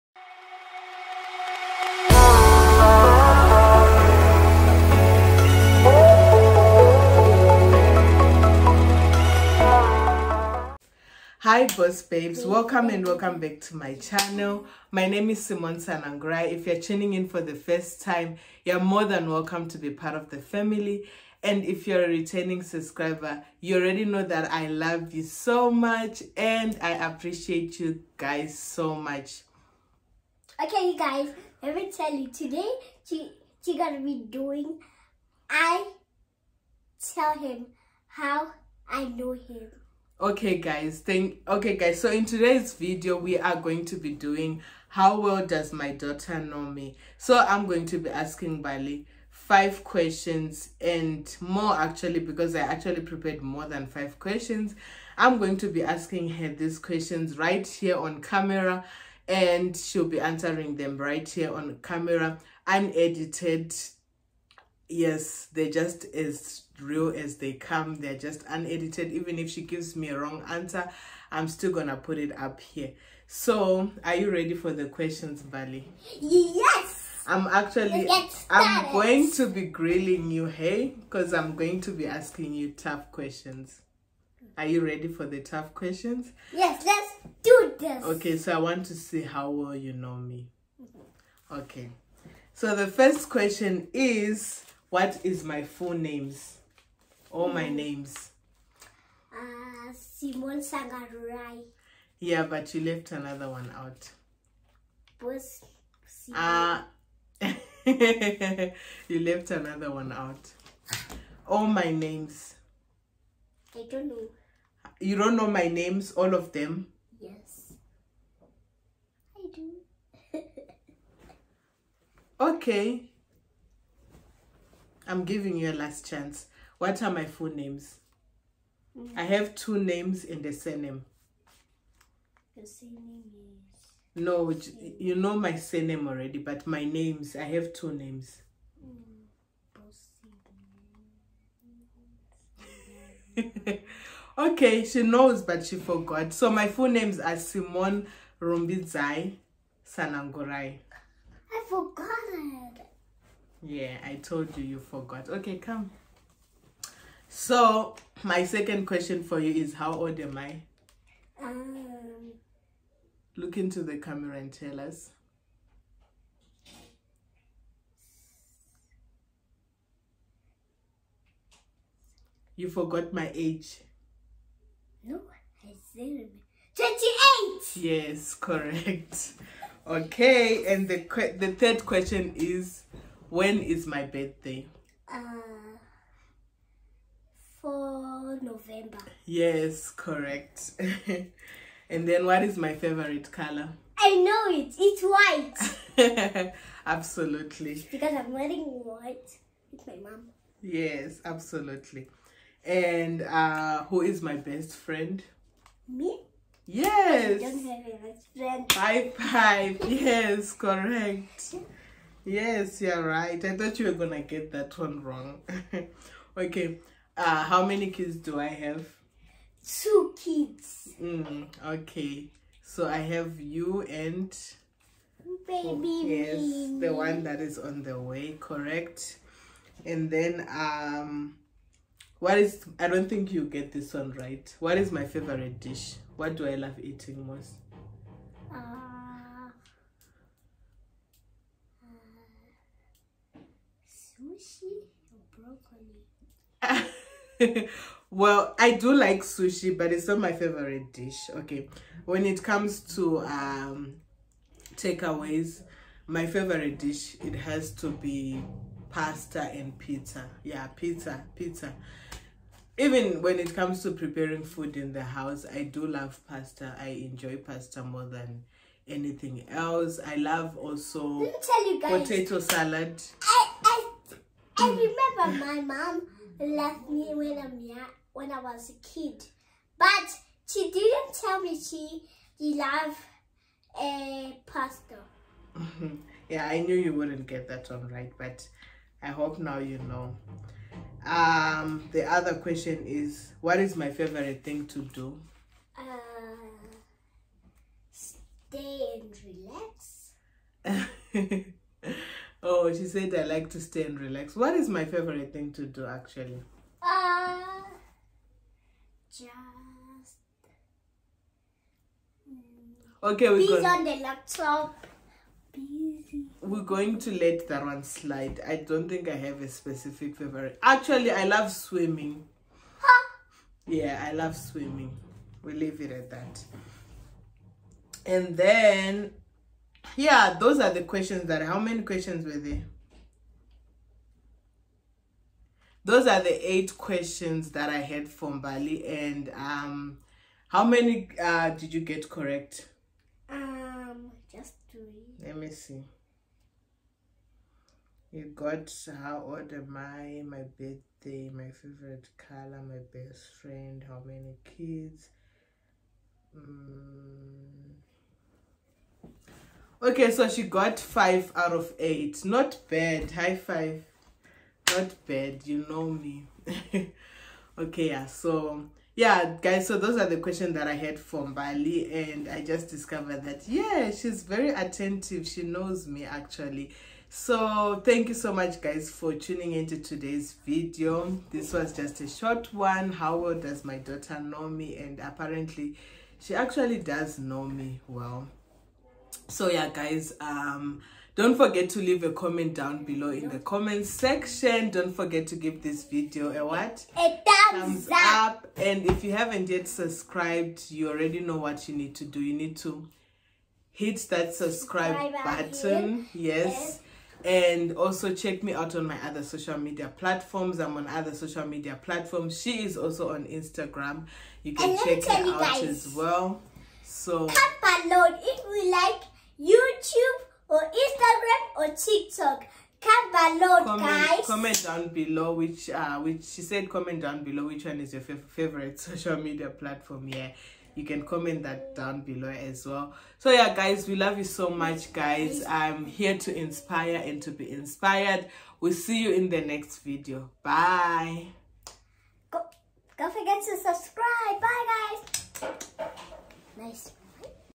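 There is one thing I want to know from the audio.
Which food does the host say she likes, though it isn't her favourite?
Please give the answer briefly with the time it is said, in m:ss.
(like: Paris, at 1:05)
Sushi, at 4:09.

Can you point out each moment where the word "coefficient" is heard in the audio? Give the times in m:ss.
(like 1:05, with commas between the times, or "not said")
not said.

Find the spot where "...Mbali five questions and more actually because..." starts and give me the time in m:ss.
0:48.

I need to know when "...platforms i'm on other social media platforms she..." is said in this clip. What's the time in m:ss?
6:49.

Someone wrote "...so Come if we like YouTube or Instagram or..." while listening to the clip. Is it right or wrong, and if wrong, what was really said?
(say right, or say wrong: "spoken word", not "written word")
right.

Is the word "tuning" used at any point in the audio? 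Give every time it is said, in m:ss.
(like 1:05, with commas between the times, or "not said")
0:16, 6:19.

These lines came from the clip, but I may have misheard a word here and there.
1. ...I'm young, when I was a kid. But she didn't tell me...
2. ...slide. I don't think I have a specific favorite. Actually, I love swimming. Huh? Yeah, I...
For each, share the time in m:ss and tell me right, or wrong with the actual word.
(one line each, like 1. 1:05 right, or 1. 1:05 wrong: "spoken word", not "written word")
1. 4:37 right
2. 5:17 right.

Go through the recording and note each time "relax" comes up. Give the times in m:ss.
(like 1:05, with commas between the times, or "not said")
4:59, 5:03.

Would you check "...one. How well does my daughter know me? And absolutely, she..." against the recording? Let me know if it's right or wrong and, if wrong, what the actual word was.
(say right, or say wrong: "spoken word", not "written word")
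wrong: "apparently", not "absolutely".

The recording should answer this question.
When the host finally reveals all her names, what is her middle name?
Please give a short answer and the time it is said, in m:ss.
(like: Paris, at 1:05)
Rumbidzai, at 2:28.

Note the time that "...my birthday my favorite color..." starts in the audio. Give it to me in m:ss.
5:50.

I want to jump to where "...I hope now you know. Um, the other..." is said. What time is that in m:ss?
4:49.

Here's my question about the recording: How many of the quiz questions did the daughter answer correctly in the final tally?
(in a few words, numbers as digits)
5.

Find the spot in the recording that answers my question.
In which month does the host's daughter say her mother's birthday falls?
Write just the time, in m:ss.
3:08.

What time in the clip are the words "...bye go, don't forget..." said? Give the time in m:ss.
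7:20.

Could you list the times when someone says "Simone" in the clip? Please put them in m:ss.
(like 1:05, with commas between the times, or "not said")
0:15, 1:39, 2:27.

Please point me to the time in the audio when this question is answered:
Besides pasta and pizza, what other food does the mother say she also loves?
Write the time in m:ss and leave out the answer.
4:31.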